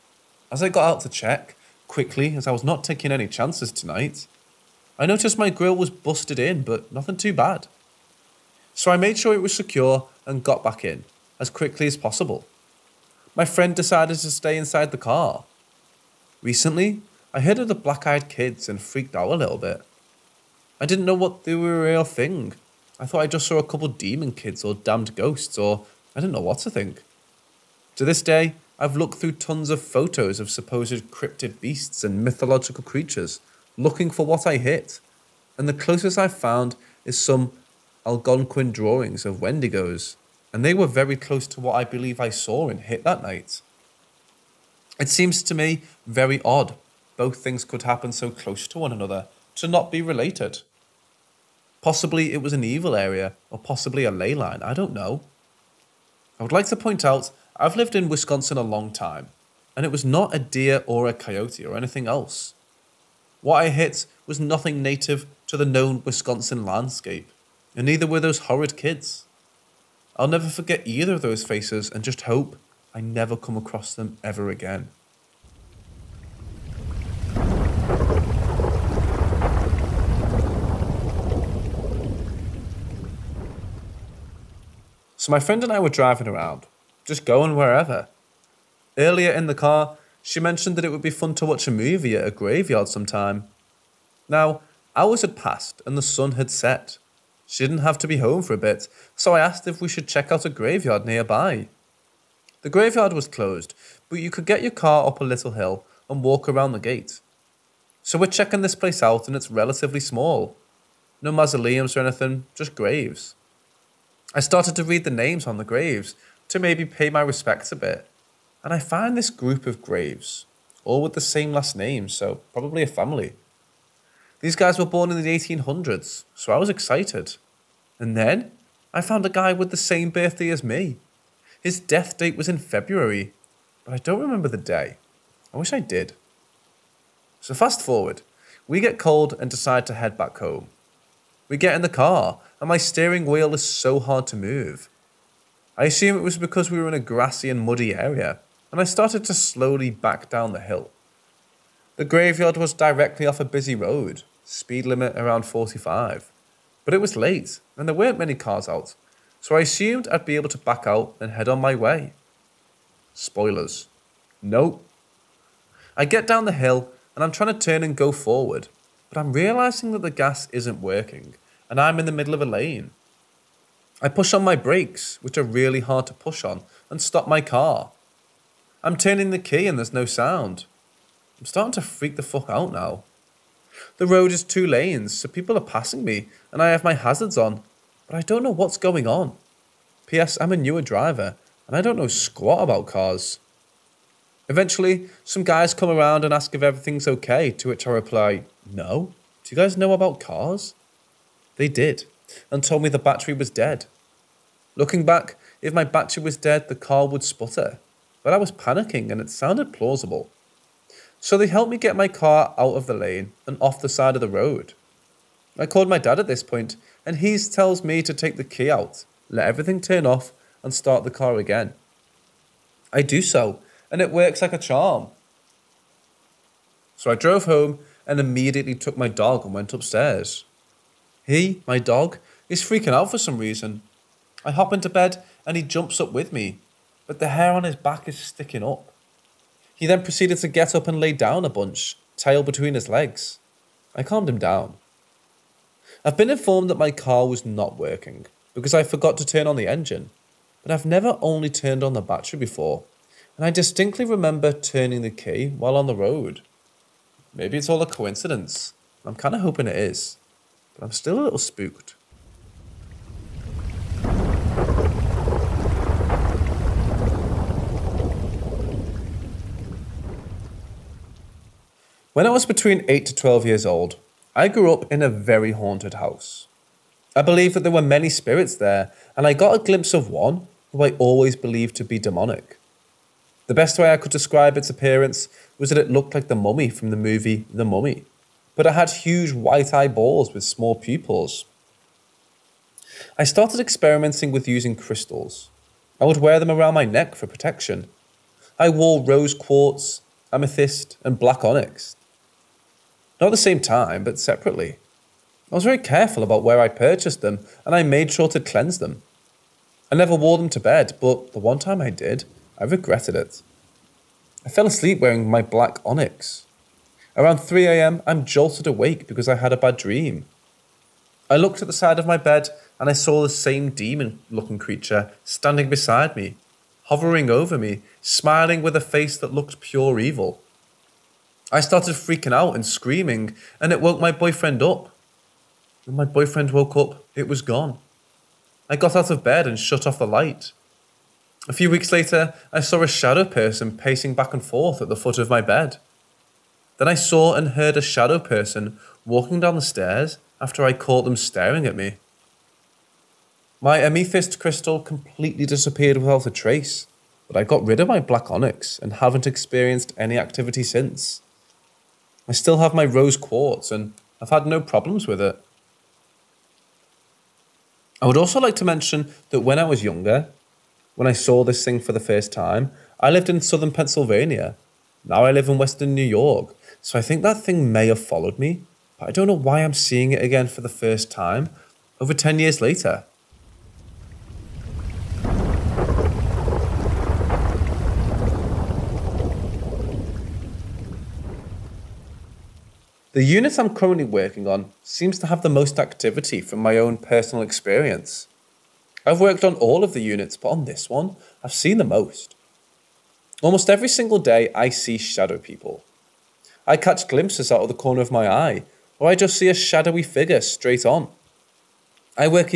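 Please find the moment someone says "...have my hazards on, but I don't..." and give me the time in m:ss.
3:06.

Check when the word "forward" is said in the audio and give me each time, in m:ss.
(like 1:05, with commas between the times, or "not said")
2:17, 2:48.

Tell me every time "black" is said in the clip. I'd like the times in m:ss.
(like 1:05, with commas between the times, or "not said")
0:17, 5:01, 5:15, 5:57.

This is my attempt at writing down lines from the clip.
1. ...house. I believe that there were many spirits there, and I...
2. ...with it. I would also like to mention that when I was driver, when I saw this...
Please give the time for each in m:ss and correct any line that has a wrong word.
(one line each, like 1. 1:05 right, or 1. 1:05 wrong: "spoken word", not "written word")
1. 4:35 right
2. 6:05 wrong: "younger", not "driver".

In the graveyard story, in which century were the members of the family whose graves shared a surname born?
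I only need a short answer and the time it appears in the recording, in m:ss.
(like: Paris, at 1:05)
1800s, at 2:05.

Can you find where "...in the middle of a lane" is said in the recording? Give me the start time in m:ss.
2:51.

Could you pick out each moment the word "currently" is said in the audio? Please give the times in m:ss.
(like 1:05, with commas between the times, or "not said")
6:33.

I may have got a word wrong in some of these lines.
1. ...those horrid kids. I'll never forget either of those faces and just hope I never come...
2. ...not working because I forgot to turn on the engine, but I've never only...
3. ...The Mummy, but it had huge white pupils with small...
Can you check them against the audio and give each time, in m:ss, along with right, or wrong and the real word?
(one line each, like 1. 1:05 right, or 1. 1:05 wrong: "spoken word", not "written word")
1. 1:08 right
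2. 4:07 right
3. 4:47 wrong: "eyeballs", not "pupils".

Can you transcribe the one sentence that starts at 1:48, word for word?
So we're checking this place out and it's relatively small.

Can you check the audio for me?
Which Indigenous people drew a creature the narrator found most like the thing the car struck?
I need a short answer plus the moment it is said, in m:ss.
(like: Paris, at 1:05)
Algonquin, at 0:38.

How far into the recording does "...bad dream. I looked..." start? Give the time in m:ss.
5:19.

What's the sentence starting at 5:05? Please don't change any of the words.
I was very careful about where I purchased them, and I made sure to cleanse them.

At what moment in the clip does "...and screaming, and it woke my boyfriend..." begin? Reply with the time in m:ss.
5:32.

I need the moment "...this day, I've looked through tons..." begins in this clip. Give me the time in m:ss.
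0:28.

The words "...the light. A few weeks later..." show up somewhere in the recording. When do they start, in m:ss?
5:39.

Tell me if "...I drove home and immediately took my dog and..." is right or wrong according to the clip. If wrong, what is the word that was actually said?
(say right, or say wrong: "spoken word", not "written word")
right.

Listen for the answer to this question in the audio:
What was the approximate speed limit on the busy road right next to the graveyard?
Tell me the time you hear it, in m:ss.
2:35.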